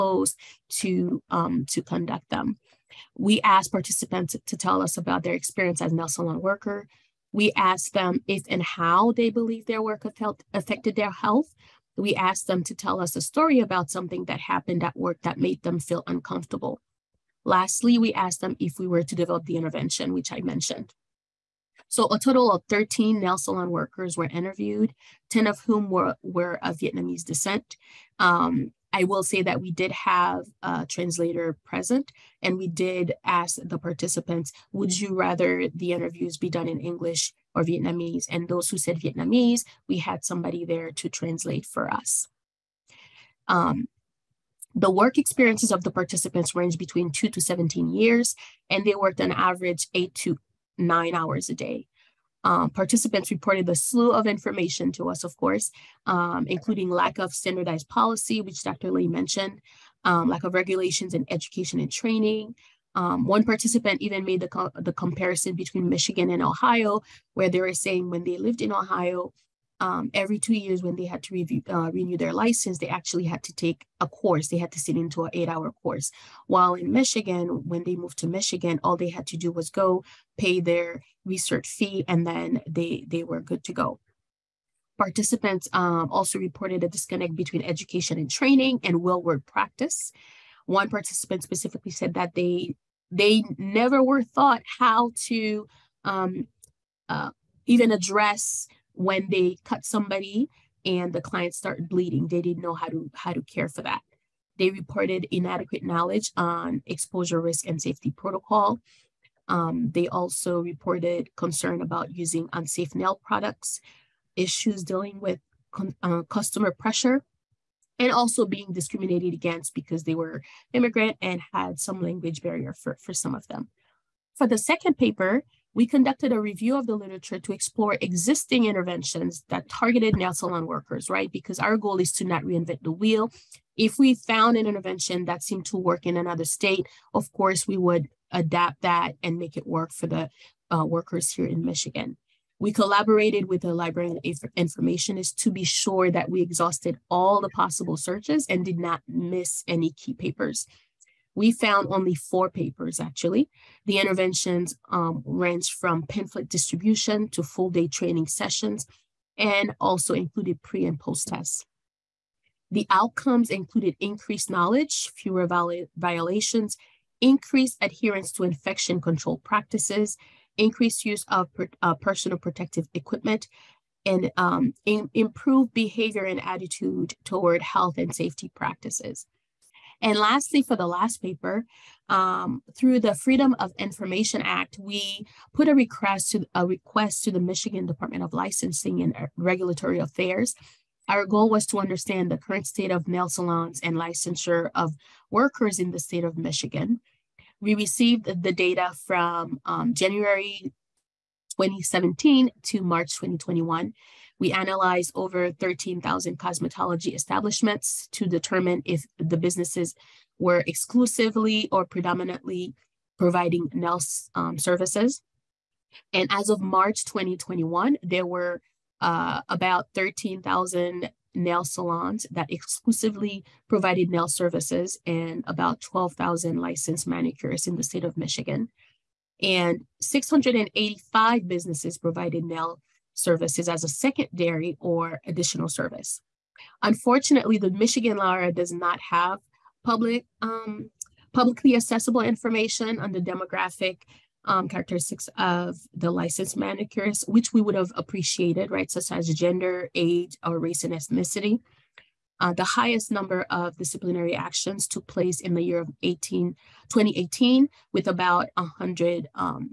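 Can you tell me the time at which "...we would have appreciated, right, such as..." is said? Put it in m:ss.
4:07.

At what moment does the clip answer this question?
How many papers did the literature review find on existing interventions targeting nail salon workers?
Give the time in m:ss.
2:32.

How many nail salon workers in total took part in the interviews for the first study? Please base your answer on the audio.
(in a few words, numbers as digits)
13.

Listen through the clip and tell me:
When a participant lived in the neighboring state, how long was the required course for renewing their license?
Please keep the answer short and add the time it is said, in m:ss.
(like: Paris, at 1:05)
8 hours, at 1:15.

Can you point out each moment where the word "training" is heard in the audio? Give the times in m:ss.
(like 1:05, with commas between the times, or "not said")
1:01, 1:28, 2:37.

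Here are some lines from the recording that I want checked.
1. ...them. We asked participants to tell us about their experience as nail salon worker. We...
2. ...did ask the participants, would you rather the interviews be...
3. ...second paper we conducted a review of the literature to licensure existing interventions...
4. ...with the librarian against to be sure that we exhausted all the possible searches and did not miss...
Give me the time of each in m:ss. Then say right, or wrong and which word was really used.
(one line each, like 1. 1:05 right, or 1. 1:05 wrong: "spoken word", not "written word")
1. 0:02 right
2. 0:32 right
3. 2:04 wrong: "explore", not "licensure"
4. 2:23 wrong: "informationist", not "against".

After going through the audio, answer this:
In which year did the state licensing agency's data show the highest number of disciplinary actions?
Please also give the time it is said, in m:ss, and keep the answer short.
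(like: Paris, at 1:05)
2018, at 4:16.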